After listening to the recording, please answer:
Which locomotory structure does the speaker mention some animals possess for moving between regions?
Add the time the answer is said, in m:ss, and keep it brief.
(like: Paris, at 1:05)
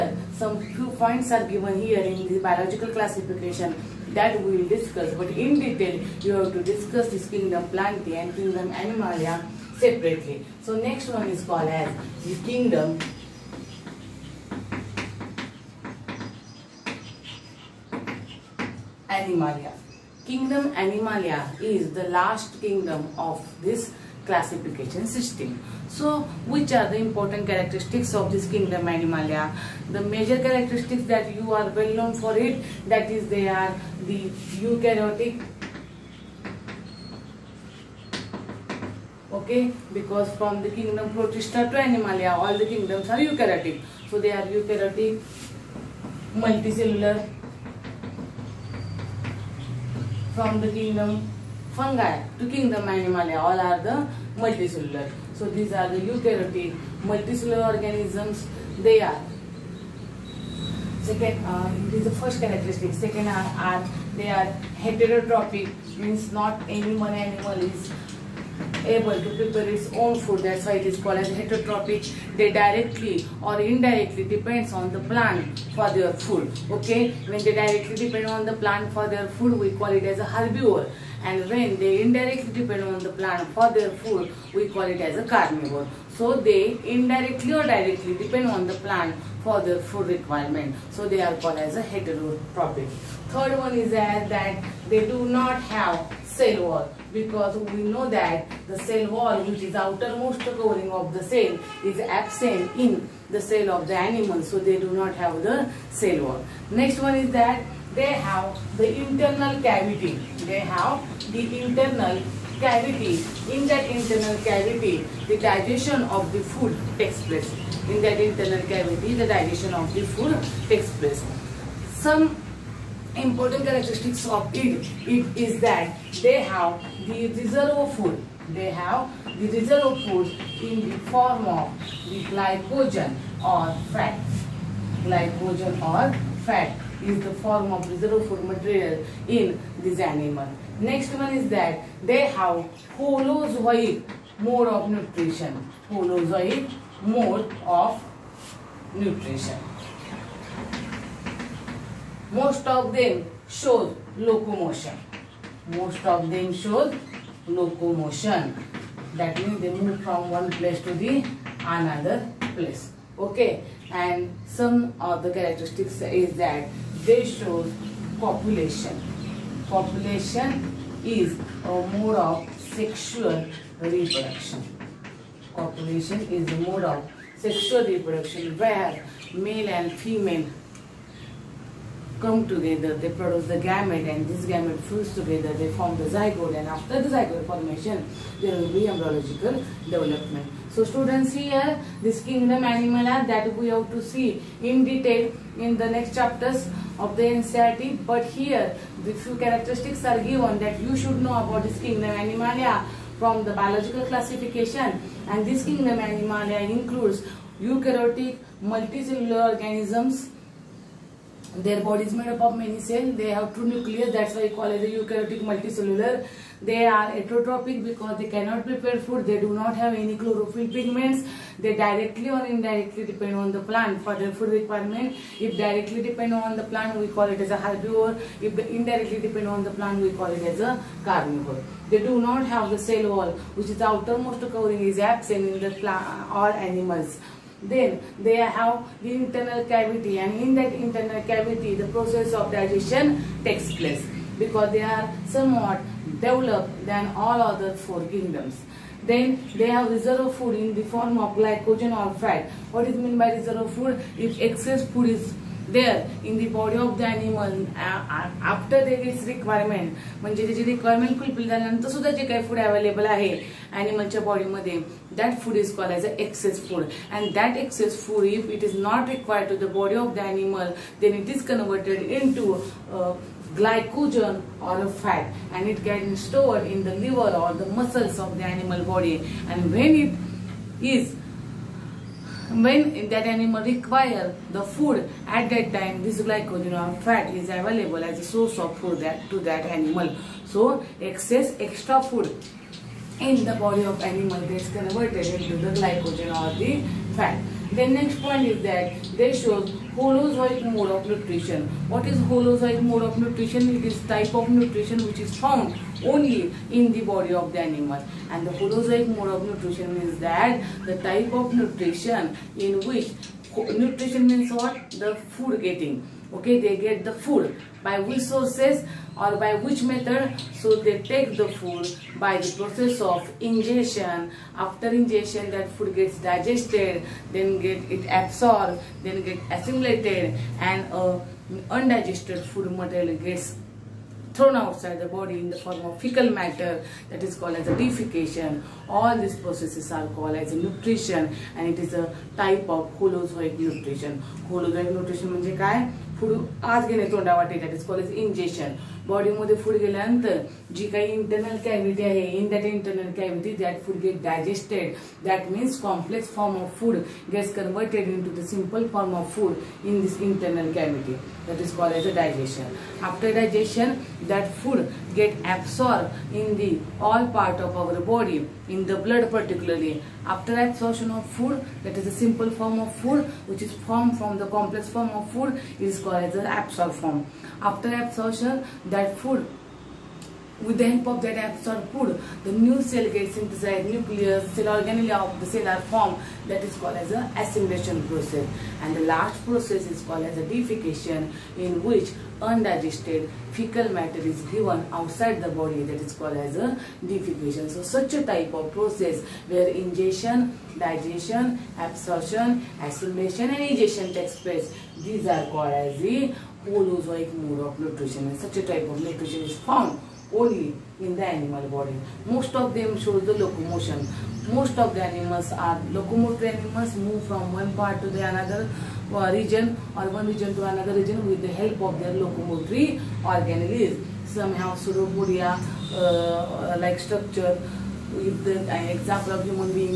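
Pseudopodia, at 7:04.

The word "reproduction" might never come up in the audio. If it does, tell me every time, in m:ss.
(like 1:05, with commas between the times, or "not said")
2:53, 2:57.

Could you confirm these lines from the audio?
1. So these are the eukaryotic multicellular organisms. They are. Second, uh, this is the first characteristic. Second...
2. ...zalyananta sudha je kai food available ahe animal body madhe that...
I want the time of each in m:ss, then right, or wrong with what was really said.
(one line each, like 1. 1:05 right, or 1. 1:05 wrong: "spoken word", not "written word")
1. 0:55 right
2. 4:21 right.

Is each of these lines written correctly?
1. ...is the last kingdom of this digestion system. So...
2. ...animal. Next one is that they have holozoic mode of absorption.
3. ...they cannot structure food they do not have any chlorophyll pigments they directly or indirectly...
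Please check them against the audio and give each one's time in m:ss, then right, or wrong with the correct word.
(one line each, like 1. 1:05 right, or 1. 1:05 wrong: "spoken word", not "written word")
1. 0:21 wrong: "classification", not "digestion"
2. 2:19 wrong: "nutrition", not "absorption"
3. 3:38 wrong: "prepare", not "structure".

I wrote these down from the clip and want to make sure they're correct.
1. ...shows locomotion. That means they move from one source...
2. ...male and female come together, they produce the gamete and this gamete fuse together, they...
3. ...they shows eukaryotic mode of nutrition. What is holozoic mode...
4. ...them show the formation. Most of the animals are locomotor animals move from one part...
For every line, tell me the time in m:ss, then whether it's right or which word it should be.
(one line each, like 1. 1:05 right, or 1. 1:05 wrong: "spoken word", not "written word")
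1. 2:36 wrong: "place", not "source"
2. 2:59 right
3. 4:59 wrong: "holozoic", not "eukaryotic"
4. 6:52 wrong: "locomotion", not "formation".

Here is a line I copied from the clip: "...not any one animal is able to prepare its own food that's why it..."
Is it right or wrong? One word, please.
right.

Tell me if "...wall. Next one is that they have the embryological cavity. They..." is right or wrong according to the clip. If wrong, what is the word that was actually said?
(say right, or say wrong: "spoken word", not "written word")
wrong: "internal", not "embryological".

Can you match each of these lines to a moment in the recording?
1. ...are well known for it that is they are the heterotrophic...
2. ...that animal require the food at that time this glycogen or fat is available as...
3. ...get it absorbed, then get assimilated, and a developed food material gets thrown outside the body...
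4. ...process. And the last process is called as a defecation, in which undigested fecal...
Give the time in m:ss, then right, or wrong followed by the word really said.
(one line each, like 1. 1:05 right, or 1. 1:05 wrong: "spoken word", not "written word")
1. 0:31 wrong: "eukaryotic", not "heterotrophic"
2. 4:43 right
3. 5:27 wrong: "undigested", not "developed"
4. 6:28 right.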